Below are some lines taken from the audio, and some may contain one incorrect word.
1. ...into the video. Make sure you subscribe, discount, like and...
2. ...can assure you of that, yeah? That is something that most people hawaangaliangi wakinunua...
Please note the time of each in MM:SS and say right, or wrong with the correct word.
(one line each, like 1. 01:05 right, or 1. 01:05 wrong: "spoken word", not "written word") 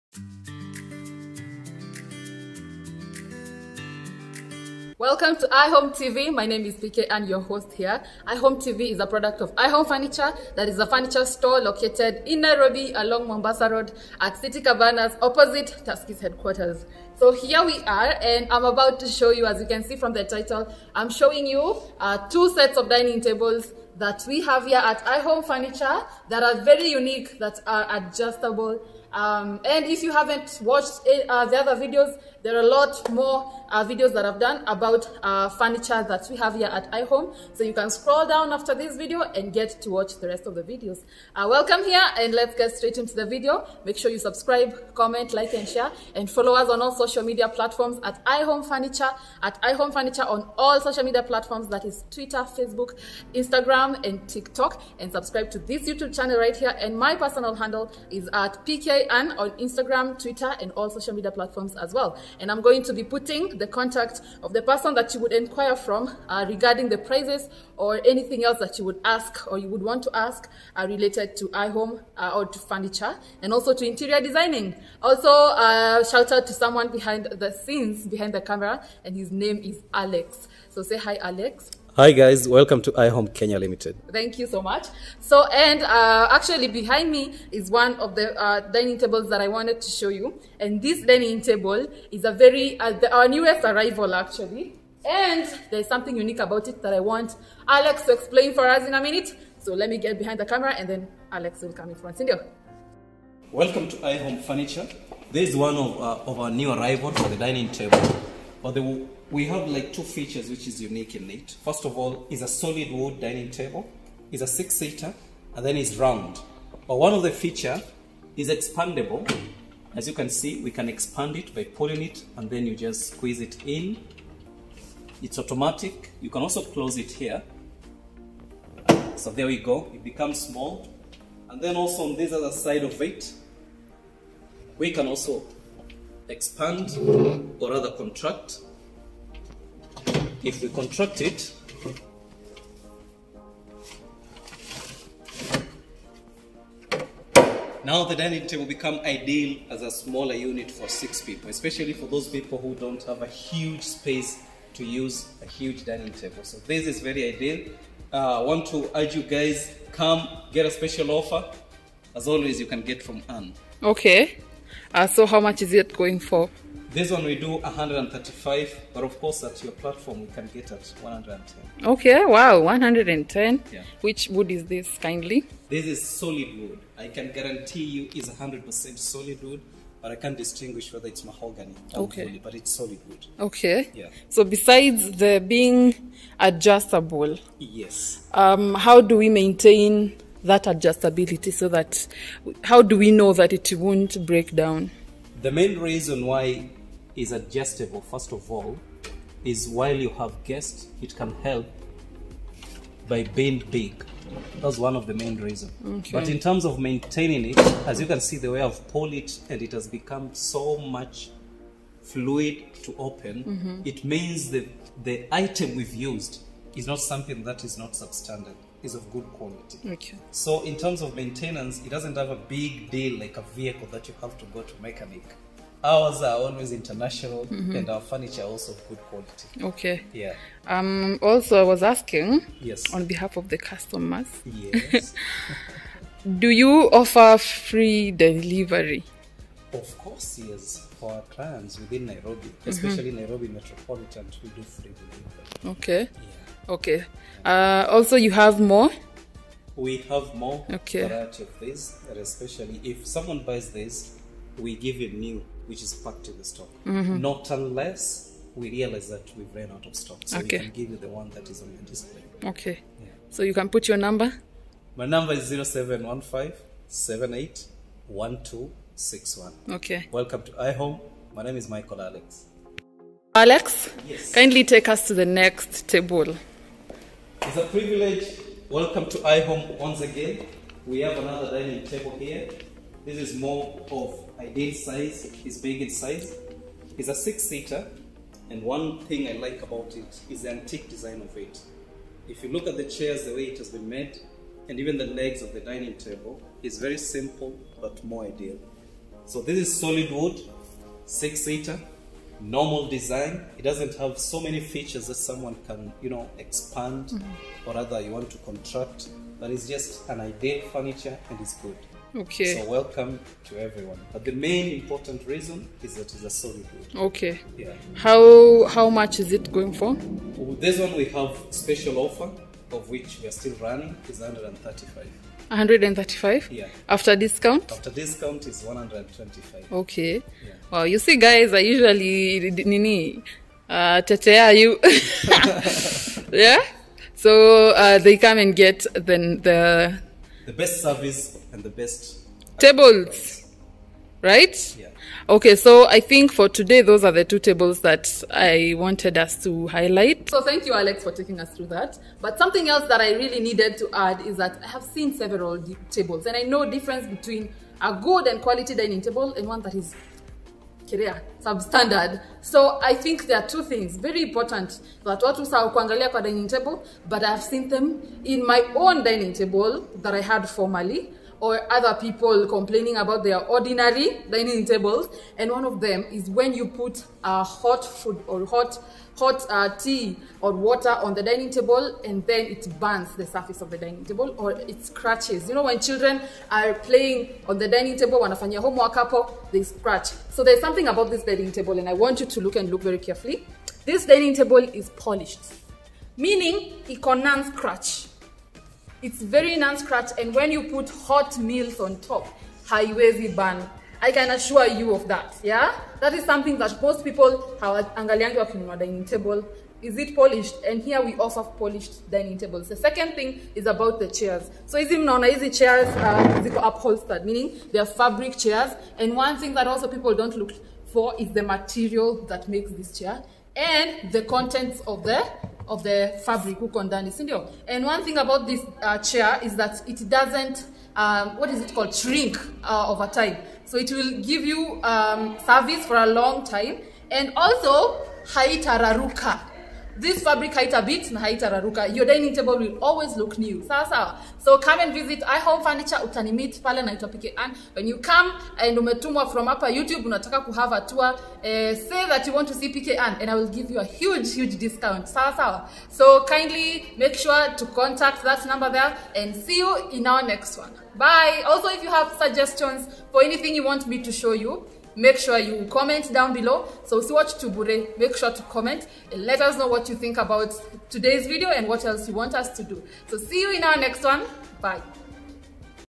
1. 00:42 wrong: "comment", not "discount"
2. 06:44 right.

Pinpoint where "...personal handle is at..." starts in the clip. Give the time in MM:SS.
00:57.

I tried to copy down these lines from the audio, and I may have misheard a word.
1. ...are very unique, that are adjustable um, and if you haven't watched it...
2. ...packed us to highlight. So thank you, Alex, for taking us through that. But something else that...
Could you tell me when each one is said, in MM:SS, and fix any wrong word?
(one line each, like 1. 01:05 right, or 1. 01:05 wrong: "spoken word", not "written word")
1. 00:26 right
2. 05:48 wrong: "wanted", not "packed".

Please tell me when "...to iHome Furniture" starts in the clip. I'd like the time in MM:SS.
01:43.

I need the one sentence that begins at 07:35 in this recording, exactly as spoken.
So kindly make sure to contact that number there and see you in our next one.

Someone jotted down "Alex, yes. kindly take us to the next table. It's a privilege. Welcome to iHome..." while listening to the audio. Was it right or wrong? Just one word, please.
right.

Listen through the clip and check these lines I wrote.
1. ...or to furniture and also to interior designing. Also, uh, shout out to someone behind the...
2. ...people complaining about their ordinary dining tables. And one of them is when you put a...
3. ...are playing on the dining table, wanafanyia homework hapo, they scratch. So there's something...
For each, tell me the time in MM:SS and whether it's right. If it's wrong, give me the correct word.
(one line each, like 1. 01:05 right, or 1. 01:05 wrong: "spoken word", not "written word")
1. 01:12 right
2. 06:11 right
3. 06:26 right.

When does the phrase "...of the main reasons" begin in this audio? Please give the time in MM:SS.
03:24.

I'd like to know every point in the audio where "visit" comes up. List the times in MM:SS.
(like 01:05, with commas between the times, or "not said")
07:24.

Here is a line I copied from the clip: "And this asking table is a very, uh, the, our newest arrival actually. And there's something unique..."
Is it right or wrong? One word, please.
wrong.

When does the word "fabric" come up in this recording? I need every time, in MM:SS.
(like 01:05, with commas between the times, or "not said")
06:57, 07:06, 07:20.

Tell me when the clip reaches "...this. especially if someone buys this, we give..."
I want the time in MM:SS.
04:11.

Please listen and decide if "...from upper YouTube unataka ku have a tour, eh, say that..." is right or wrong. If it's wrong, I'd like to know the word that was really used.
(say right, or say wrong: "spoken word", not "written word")
right.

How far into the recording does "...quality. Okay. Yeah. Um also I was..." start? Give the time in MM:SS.
03:49.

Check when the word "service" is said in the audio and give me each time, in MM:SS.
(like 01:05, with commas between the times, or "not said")
05:40, 07:15.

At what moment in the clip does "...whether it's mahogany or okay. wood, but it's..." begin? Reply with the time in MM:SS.
03:00.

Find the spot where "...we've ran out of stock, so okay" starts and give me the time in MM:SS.
04:19.